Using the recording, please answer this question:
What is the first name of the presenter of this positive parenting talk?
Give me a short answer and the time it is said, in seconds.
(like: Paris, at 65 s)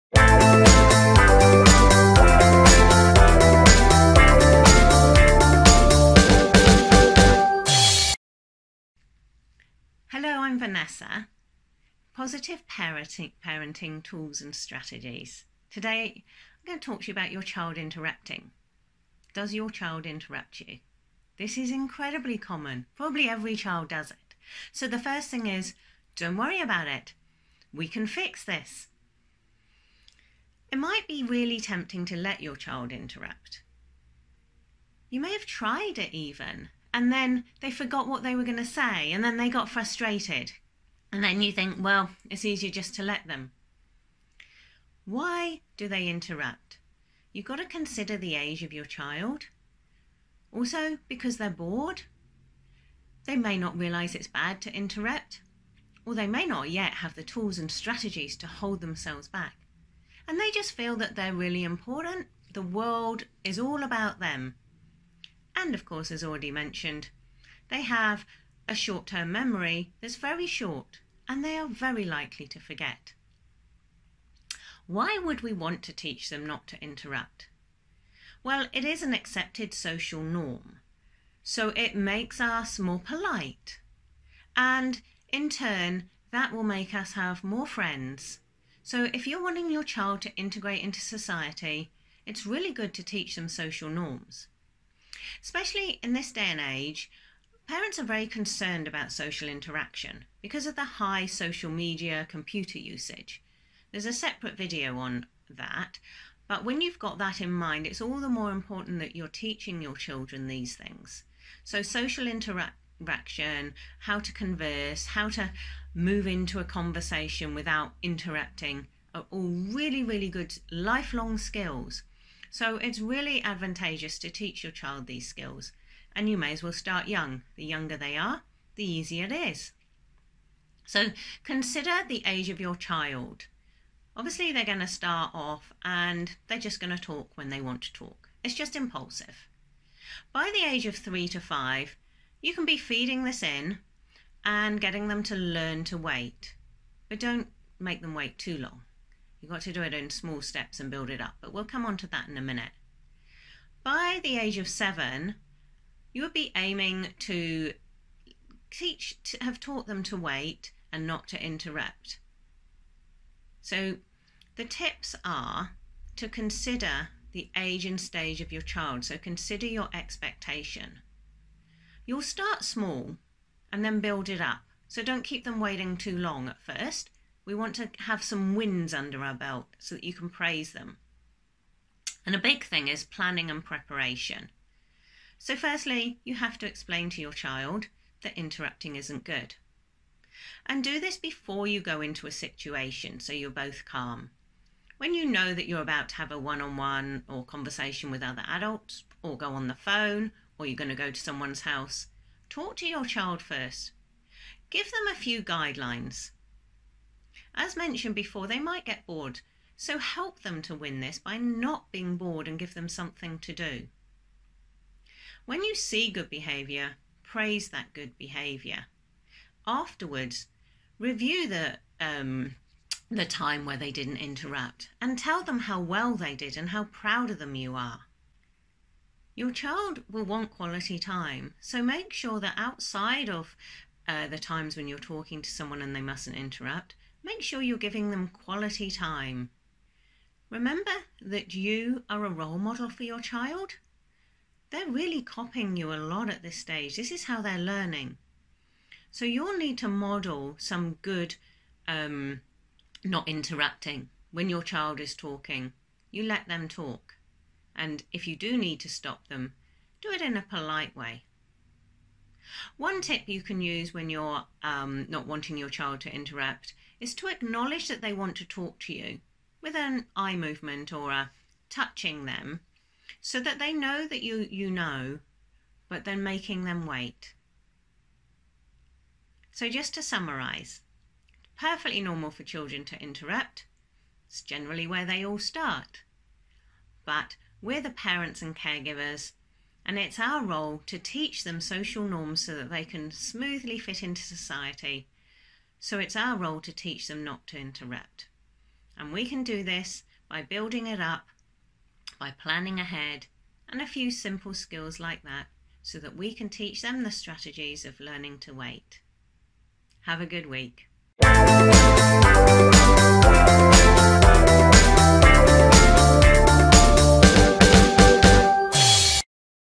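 Vanessa, at 10 s.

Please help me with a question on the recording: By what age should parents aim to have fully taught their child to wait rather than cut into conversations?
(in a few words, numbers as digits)
7.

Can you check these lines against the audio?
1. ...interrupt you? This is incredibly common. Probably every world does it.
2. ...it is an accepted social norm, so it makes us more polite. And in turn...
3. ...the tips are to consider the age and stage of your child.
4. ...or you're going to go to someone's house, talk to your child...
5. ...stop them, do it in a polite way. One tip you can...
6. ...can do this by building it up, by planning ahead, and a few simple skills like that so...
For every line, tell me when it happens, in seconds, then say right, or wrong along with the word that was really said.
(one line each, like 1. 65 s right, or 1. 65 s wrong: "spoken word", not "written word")
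1. 20 s wrong: "child", not "world"
2. 78 s right
3. 164 s right
4. 200 s right
5. 258 s right
6. 299 s right.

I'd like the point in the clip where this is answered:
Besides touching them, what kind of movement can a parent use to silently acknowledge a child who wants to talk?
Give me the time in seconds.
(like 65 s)
270 s.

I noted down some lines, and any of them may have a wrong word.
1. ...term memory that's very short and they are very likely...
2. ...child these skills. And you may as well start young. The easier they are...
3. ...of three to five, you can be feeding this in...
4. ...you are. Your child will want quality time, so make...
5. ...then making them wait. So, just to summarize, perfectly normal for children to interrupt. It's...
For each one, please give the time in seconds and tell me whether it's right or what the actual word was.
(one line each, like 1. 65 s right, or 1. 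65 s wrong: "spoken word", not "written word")
1. 69 s right
2. 124 s wrong: "younger", not "easier"
3. 140 s right
4. 227 s right
5. 276 s right.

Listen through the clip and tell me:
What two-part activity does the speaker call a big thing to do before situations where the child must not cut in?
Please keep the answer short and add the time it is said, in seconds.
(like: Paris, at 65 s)
planning and preparation, at 183 s.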